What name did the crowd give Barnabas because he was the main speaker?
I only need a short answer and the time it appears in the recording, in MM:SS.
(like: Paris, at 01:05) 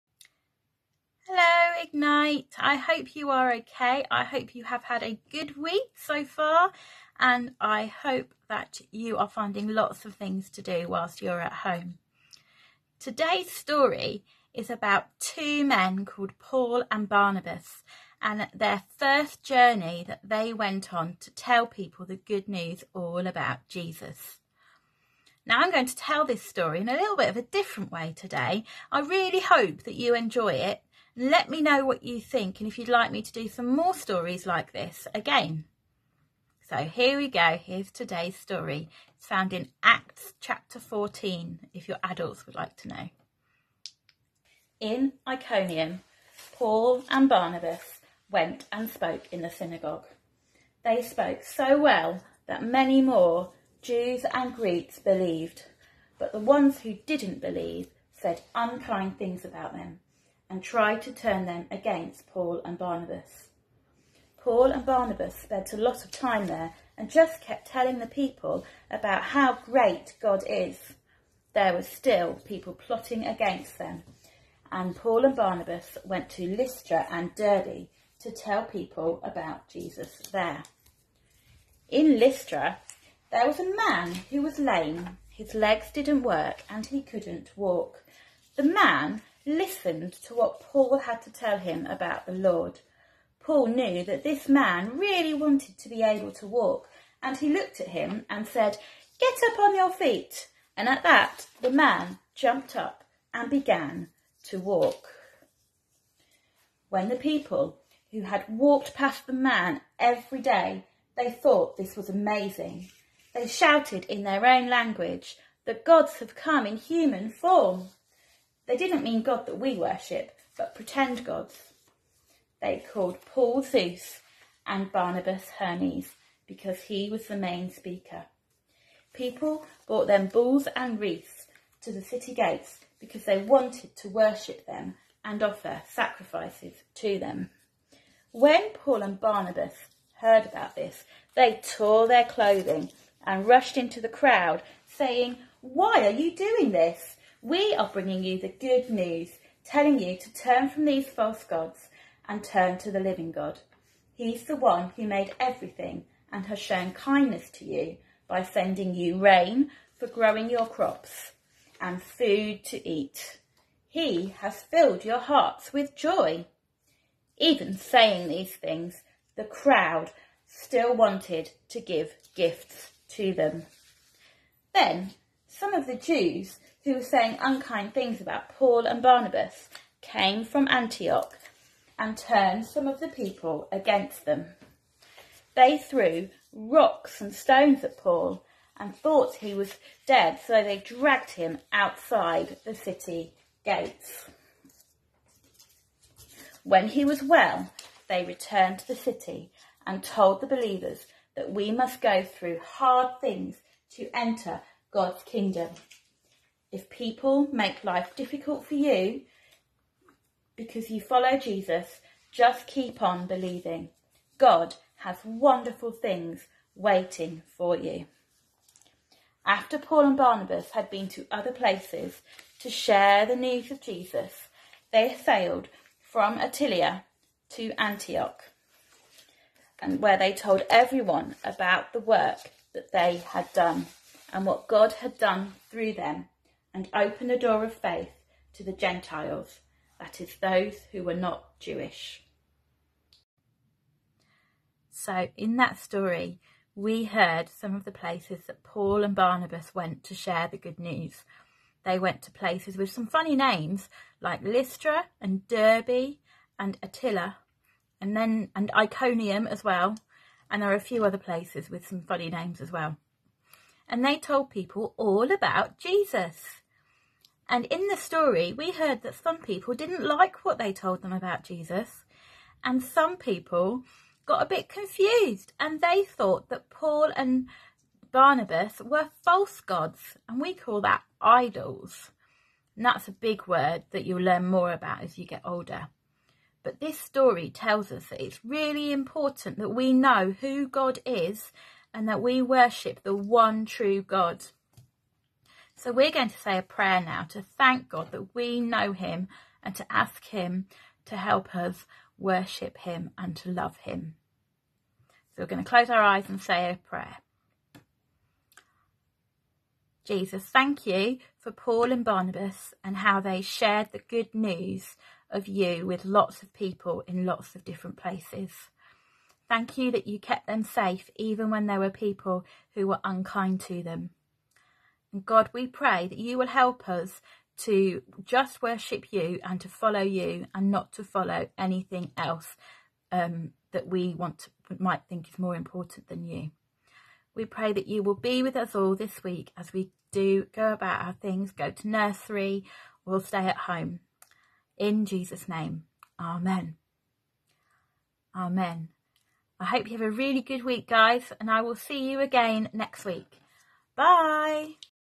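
Hermes, at 02:05.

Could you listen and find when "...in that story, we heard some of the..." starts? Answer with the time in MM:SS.
04:05.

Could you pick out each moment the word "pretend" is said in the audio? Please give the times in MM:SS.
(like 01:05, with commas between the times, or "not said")
02:00.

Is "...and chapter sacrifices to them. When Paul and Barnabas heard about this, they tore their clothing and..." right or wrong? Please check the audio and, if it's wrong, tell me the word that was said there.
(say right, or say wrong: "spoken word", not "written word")
wrong: "offer", not "chapter".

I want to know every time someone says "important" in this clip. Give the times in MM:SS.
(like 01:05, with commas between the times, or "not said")
04:48, 05:35.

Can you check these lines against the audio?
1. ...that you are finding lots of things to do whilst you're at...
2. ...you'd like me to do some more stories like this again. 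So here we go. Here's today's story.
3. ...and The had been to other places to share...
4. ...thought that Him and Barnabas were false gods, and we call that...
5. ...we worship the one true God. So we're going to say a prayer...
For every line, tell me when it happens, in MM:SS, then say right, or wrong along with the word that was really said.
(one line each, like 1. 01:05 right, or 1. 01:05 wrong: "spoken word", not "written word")
1. 00:08 right
2. 00:32 right
3. 03:40 wrong: "Barnabas", not "The"
4. 04:36 wrong: "Paul", not "Him"
5. 04:52 right.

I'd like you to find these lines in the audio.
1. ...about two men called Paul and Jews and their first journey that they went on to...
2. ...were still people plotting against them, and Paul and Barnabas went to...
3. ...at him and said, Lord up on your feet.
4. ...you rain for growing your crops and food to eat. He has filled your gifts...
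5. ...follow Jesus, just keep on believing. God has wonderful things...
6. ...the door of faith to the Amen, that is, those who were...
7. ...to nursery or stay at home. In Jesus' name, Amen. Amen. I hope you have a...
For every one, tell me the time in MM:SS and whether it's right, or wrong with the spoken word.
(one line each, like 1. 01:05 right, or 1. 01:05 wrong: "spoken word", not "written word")
1. 00:14 wrong: "Barnabas", not "Jews"
2. 01:11 right
3. 01:37 wrong: "Get", not "Lord"
4. 02:38 wrong: "hearts", not "gifts"
5. 03:31 right
6. 03:57 wrong: "Gentiles", not "Amen"
7. 05:41 right.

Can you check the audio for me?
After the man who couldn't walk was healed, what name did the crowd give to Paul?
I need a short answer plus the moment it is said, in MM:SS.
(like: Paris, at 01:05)
Zeus, at 02:03.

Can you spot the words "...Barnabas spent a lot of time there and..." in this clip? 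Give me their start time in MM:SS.
01:04.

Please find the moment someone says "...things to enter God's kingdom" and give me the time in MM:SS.
03:23.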